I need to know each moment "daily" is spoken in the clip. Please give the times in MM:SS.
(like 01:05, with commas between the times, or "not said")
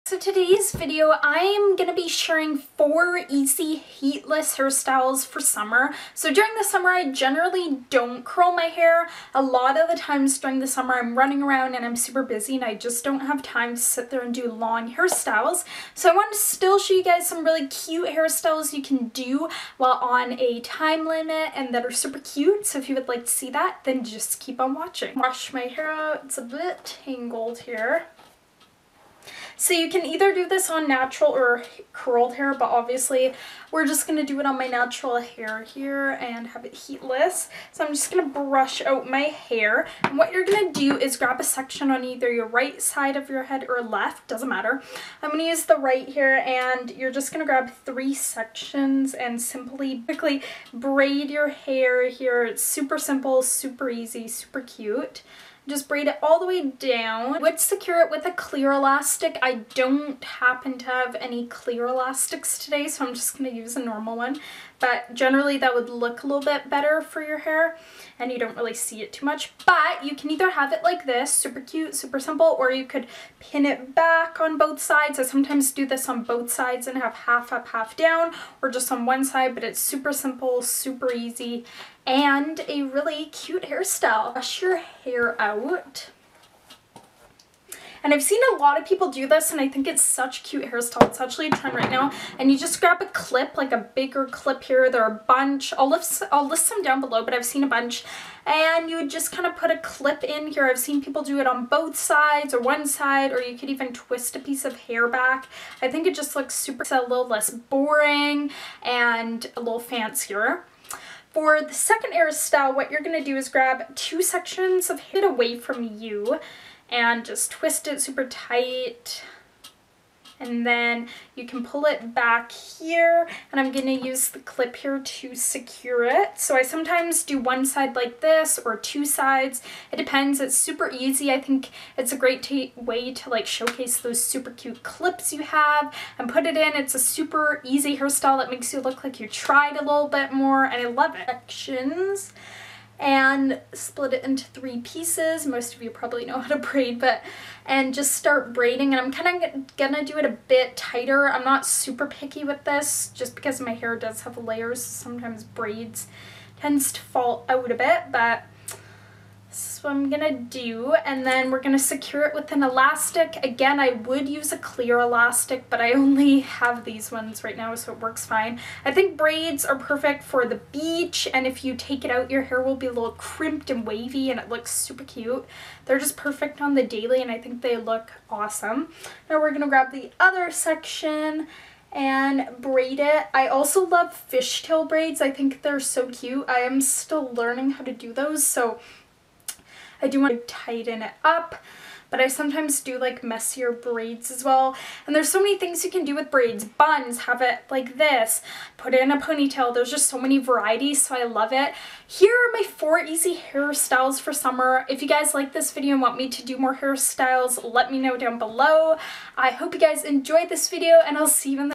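02:56.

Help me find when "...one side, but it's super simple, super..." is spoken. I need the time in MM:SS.
01:19.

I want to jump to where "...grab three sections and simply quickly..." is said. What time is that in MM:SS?
00:47.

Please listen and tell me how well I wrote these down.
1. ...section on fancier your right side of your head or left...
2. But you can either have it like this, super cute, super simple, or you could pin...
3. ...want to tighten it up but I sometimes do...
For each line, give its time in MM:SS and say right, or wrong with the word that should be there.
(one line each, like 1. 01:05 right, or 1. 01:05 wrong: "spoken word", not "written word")
1. 00:41 wrong: "either", not "fancier"
2. 01:09 right
3. 03:10 right.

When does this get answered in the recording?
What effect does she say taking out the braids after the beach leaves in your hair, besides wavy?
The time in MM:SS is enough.
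02:53.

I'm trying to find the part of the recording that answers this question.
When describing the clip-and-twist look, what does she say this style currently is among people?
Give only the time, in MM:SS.
01:31.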